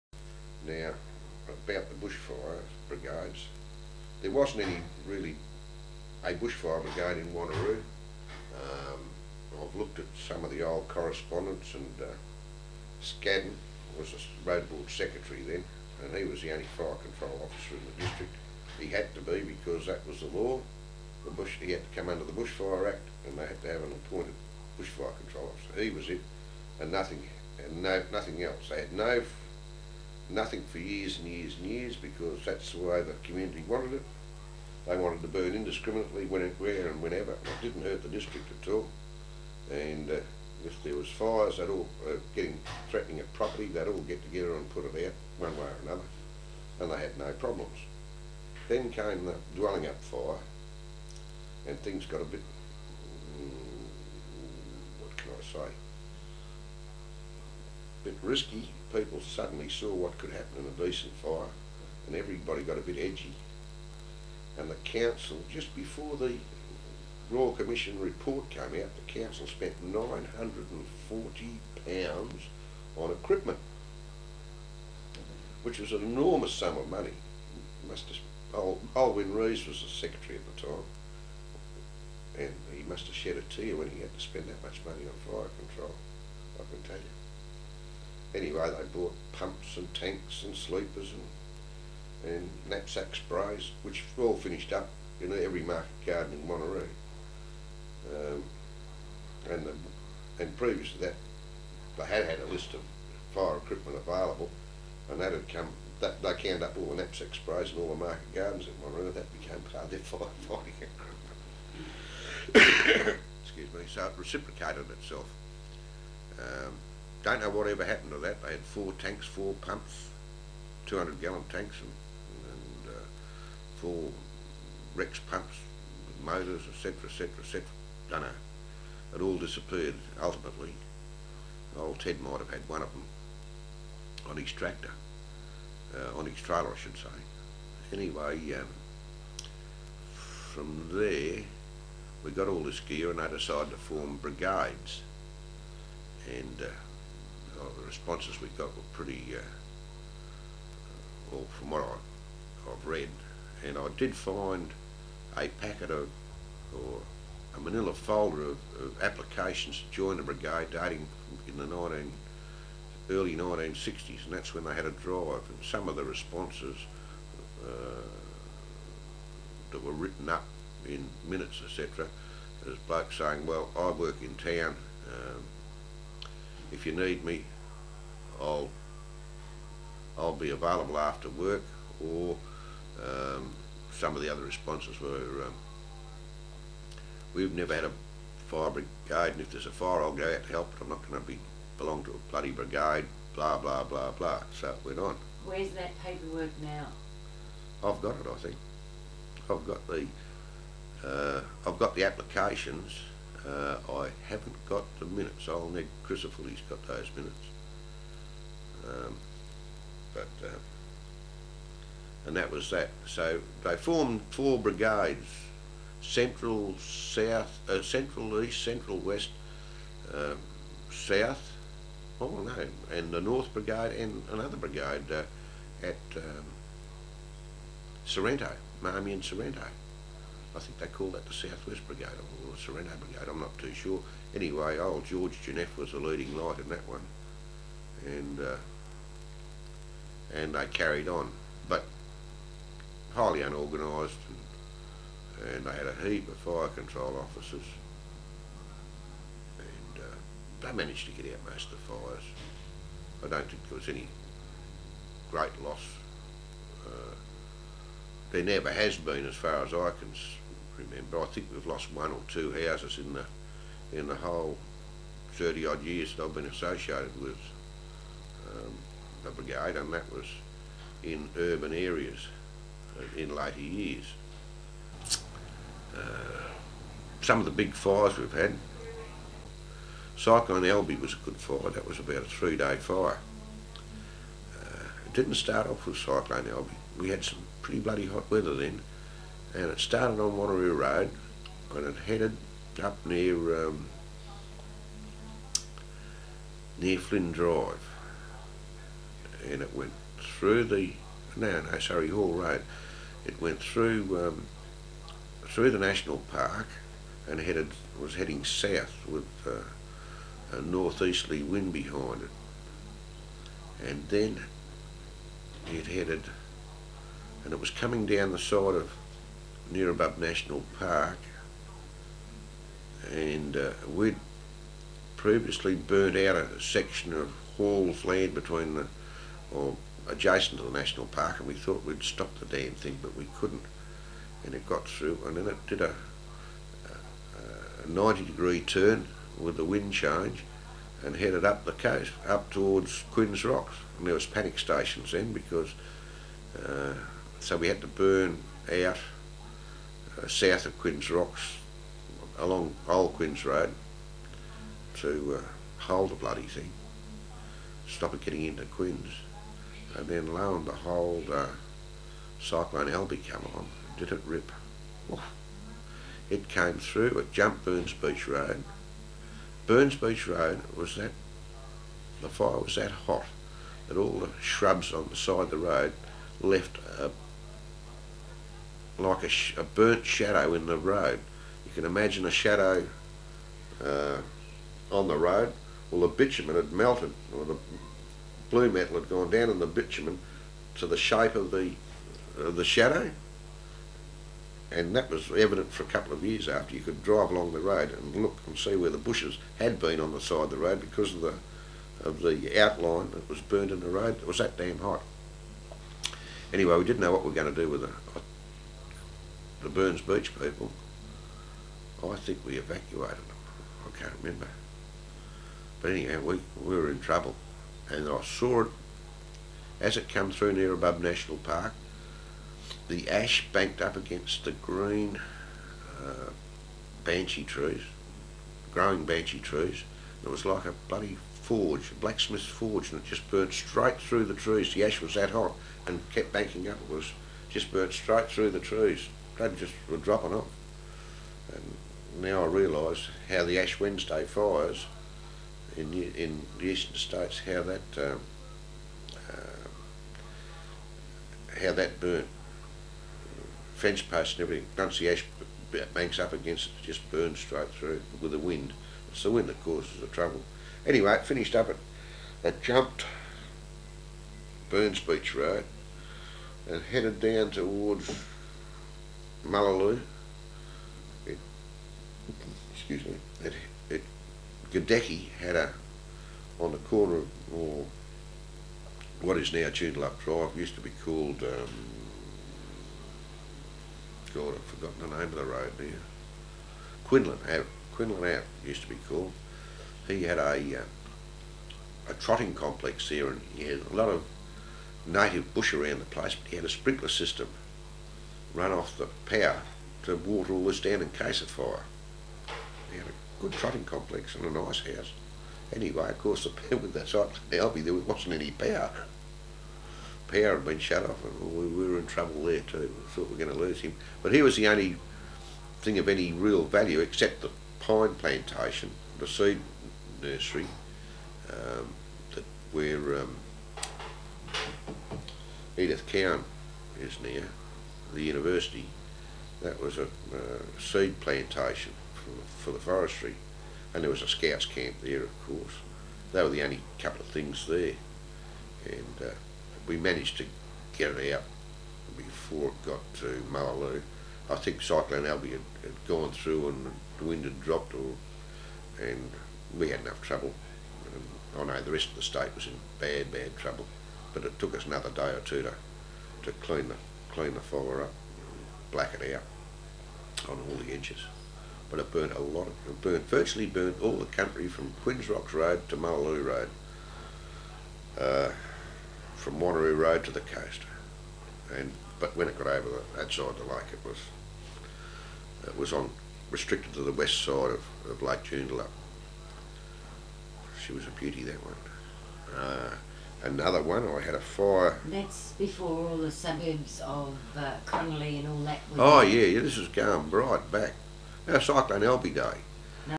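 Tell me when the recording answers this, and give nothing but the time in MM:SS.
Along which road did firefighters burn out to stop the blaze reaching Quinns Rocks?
05:52.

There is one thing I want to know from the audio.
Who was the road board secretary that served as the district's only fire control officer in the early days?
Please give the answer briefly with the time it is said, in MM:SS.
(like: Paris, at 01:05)
Scadden, at 00:13.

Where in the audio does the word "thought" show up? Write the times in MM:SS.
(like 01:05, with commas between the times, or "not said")
05:31, 08:33.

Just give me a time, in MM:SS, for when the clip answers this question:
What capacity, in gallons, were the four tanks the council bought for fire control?
02:00.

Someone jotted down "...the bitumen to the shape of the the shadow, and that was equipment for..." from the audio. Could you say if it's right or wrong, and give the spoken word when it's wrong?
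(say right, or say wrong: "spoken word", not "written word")
wrong: "evident", not "equipment".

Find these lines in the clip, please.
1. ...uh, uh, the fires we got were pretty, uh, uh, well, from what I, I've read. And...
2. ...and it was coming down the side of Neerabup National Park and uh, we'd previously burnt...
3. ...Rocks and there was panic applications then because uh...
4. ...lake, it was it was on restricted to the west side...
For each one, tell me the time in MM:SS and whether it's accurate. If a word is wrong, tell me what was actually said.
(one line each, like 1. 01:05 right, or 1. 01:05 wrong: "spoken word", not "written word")
1. 02:26 wrong: "responses", not "fires"
2. 05:17 right
3. 05:43 wrong: "stations", not "applications"
4. 09:33 right.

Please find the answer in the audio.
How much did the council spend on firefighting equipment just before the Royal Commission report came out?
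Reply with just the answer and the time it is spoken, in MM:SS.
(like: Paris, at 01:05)
£940, at 01:09.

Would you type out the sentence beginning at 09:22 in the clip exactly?
Of, it burnt virtually burnt all the country from Quinns Rocks Road to Mullaloo Road, uh, from Wanneroo Road to the coast.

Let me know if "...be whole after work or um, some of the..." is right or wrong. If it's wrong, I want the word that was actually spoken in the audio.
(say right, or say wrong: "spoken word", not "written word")
wrong: "available", not "whole".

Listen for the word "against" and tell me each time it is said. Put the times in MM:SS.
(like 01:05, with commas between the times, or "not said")
07:03, 07:36.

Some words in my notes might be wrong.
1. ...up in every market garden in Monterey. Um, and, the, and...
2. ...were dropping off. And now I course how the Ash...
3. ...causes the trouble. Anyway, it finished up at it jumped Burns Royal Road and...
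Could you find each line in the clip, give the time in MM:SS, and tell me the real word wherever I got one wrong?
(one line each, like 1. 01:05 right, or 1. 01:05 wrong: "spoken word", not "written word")
1. 01:34 right
2. 07:19 wrong: "realise", not "course"
3. 07:39 wrong: "Beach", not "Royal".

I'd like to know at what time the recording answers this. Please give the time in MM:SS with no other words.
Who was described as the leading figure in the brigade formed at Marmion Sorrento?
03:55.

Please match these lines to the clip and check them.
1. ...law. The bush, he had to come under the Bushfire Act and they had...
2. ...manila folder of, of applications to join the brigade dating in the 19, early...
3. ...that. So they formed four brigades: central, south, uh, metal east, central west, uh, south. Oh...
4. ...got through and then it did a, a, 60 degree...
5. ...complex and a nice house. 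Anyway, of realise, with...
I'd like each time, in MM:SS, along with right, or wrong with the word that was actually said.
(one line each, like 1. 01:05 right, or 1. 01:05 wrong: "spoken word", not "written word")
1. 00:20 right
2. 02:37 right
3. 03:32 wrong: "central", not "metal"
4. 05:34 wrong: "90", not "60"
5. 08:23 wrong: "course", not "realise".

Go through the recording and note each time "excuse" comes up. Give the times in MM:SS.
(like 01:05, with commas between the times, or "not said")
01:53, 07:52.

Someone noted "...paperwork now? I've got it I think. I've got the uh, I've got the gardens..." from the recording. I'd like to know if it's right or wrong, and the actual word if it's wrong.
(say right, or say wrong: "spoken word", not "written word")
wrong: "applications", not "gardens".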